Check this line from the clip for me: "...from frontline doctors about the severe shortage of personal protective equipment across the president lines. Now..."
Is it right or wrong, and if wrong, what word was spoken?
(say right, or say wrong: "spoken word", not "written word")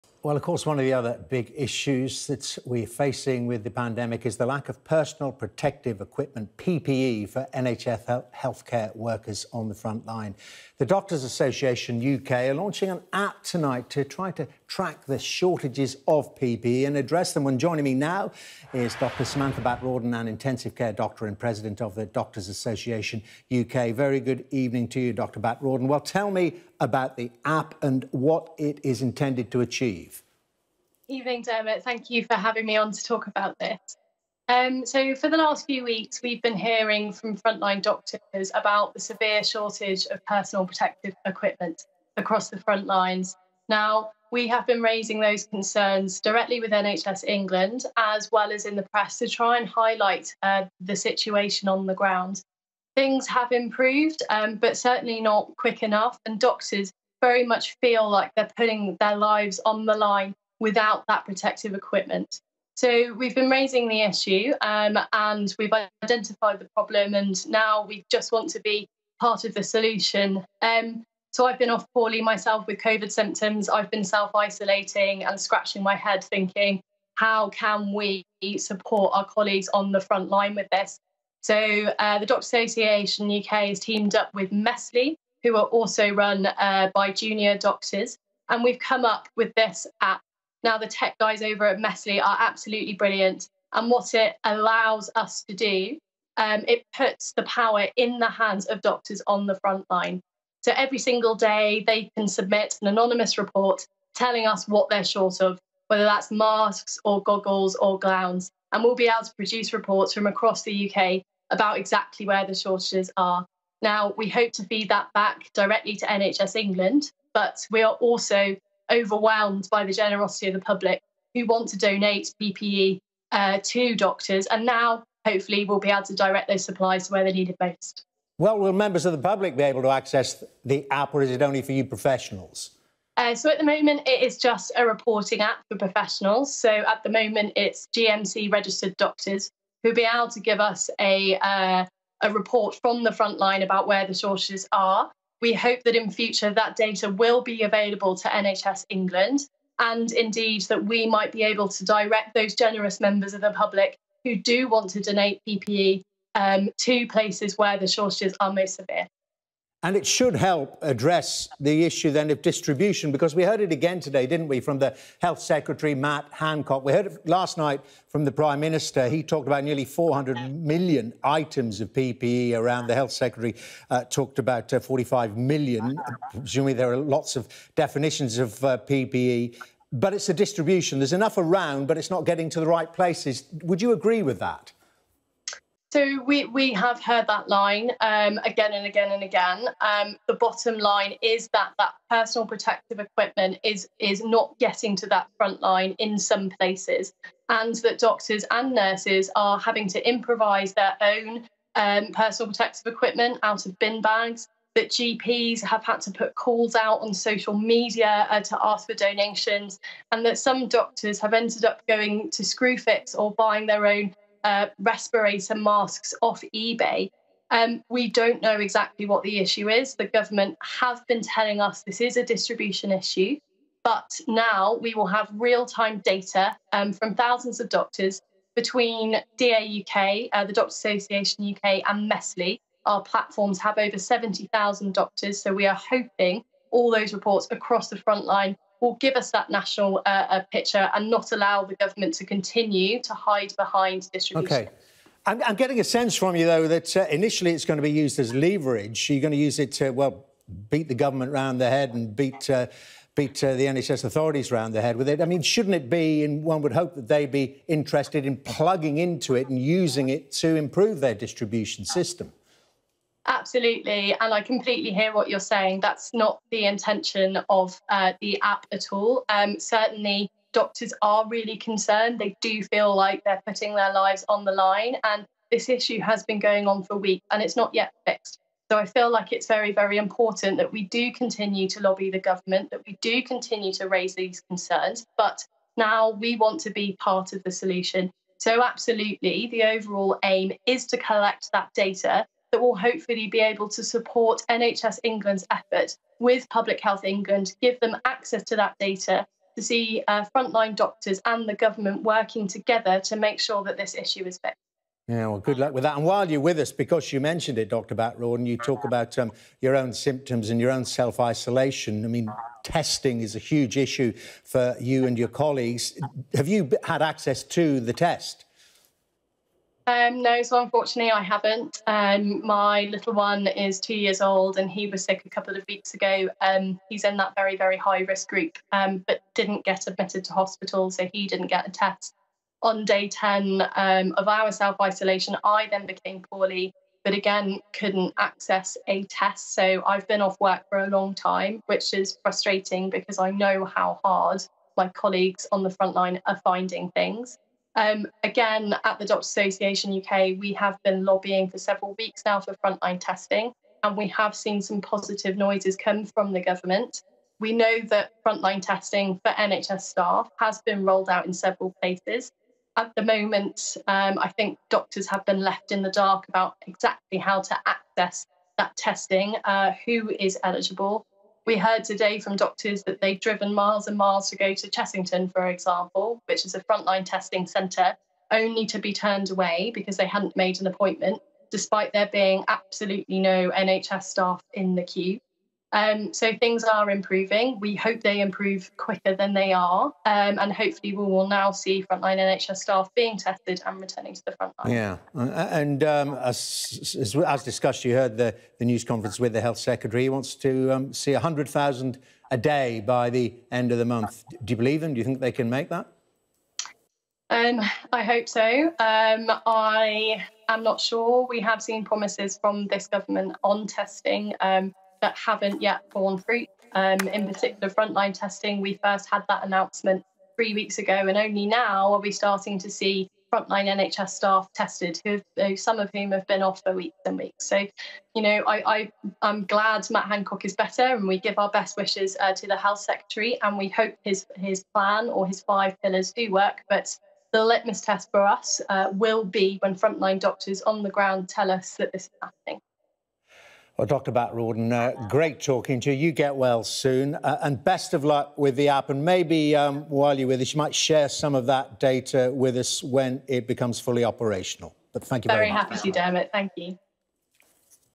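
wrong: "front", not "president".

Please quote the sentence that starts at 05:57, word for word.
We know that frontline testing for NHS staff has been rolled out in several places.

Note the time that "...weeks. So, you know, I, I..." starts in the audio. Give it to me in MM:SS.
07:07.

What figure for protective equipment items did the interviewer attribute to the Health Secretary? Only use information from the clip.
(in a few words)
45 million.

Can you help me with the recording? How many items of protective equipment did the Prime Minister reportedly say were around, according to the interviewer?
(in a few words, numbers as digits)
nearly 400 million.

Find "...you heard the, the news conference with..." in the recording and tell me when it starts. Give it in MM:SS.
06:37.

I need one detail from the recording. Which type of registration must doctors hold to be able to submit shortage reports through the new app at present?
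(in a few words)
GMC registered.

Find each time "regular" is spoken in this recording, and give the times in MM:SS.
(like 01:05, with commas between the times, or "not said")
not said.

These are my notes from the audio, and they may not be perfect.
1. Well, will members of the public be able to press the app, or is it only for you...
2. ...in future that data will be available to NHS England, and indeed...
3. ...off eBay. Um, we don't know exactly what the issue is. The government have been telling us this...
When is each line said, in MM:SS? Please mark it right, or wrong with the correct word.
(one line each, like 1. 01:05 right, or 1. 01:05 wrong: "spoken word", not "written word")
1. 02:08 wrong: "access", not "press"
2. 02:25 right
3. 03:36 right.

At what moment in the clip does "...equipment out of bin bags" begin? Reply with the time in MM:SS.
03:22.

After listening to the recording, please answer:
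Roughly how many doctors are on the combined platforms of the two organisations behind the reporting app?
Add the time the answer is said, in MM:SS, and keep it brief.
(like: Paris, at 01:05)
over 70,000, at 03:53.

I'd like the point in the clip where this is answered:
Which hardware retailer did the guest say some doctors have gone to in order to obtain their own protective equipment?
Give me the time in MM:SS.
03:32.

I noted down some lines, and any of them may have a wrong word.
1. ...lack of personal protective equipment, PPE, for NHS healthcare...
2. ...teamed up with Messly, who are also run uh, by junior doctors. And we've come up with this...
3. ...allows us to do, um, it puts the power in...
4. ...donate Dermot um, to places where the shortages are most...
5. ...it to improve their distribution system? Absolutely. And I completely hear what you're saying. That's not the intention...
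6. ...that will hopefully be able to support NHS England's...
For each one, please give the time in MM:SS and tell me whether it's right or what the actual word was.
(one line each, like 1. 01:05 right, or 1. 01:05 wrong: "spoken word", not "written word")
1. 00:04 right
2. 01:23 right
3. 01:34 right
4. 02:34 wrong: "PPE", not "Dermot"
5. 04:20 right
6. 04:52 right.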